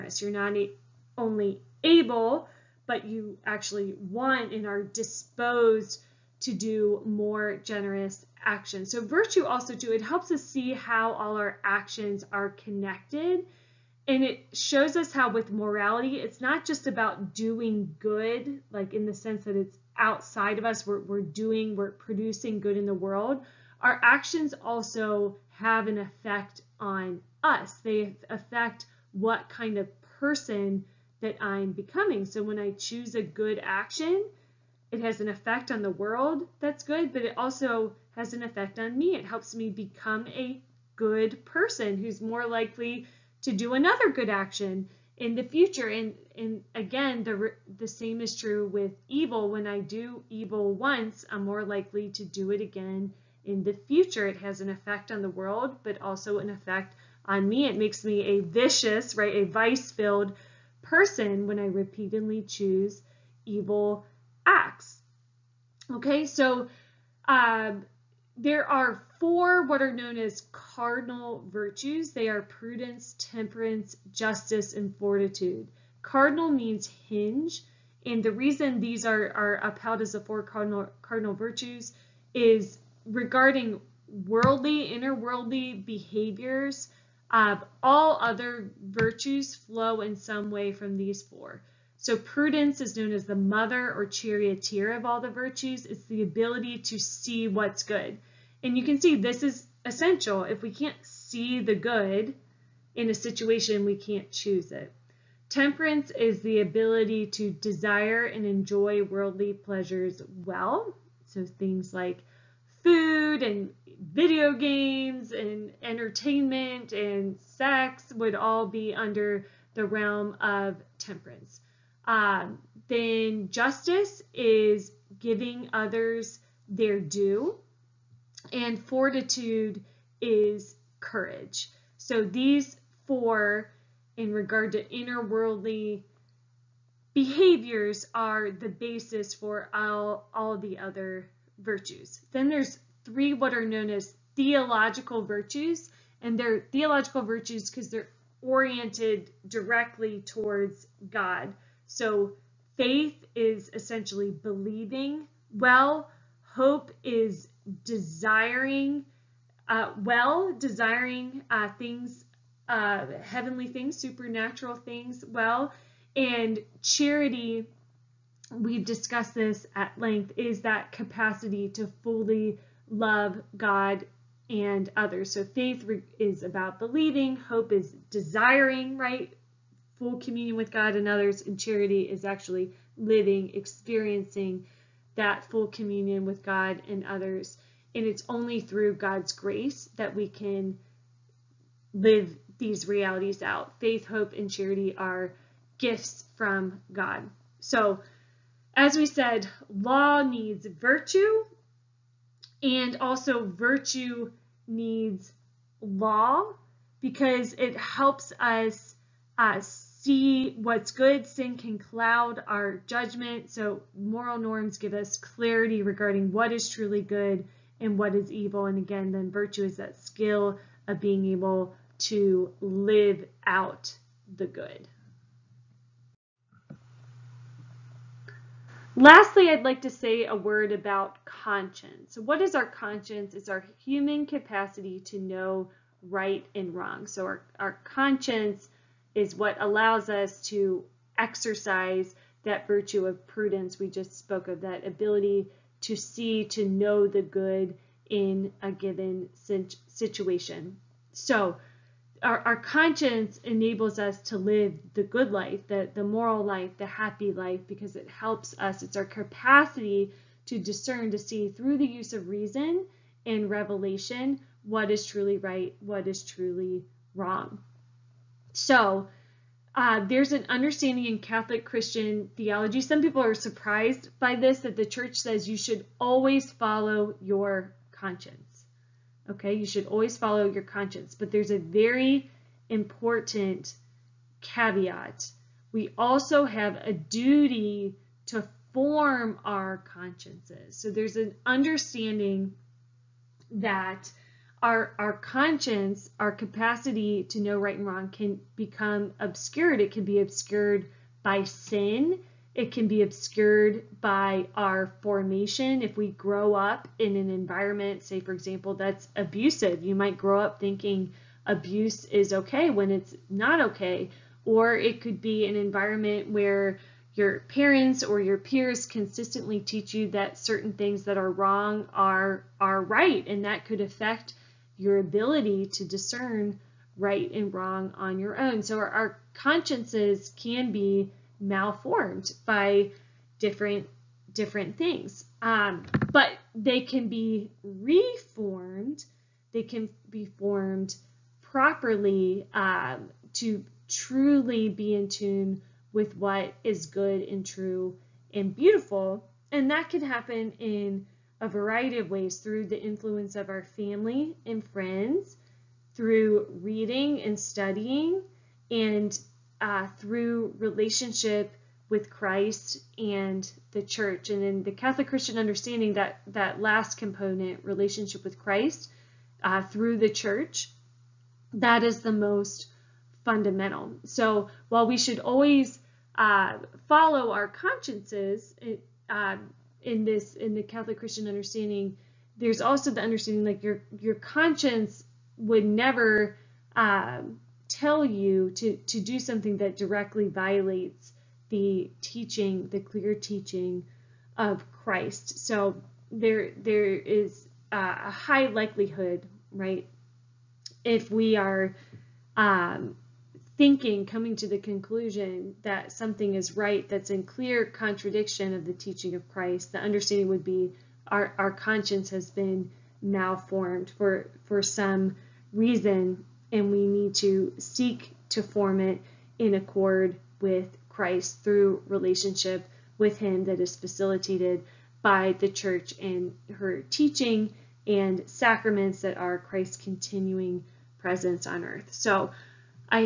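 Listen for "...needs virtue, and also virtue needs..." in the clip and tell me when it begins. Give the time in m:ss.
3:20.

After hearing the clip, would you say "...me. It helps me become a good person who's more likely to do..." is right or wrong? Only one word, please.
right.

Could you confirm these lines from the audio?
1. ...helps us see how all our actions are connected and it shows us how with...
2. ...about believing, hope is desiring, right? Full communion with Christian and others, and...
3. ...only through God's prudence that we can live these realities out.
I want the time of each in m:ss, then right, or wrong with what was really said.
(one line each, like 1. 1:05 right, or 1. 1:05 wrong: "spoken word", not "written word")
1. 0:10 right
2. 2:56 wrong: "God", not "Christian"
3. 3:08 wrong: "grace", not "prudence".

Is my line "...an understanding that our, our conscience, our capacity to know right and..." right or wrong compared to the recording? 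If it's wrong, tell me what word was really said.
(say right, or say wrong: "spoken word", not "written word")
right.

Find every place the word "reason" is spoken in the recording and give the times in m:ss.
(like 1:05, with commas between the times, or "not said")
1:18, 4:22, 6:55.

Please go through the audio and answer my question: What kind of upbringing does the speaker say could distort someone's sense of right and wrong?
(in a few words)
Abusive.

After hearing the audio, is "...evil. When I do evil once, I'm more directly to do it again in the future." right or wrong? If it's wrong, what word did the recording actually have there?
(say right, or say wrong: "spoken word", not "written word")
wrong: "likely", not "directly".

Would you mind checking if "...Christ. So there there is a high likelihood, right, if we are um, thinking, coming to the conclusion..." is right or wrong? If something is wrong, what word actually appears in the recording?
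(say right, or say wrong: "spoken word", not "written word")
right.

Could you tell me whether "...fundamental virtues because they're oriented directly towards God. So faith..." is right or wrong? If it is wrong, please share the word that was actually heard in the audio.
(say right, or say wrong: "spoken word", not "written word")
wrong: "theological", not "fundamental".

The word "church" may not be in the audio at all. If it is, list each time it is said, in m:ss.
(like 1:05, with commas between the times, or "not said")
4:34, 6:03, 6:10, 7:05.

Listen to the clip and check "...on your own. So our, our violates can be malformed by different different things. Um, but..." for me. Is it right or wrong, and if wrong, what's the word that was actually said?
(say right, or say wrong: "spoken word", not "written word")
wrong: "consciences", not "violates".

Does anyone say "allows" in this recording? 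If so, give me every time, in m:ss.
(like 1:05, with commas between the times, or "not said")
3:59.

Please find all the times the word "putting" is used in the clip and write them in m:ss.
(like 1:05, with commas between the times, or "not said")
not said.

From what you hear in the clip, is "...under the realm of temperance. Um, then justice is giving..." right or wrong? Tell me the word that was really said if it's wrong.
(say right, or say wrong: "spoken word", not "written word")
right.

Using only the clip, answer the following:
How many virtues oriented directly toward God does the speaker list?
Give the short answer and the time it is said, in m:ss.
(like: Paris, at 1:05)
3, at 2:23.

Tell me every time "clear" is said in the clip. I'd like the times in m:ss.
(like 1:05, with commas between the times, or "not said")
6:32, 6:47.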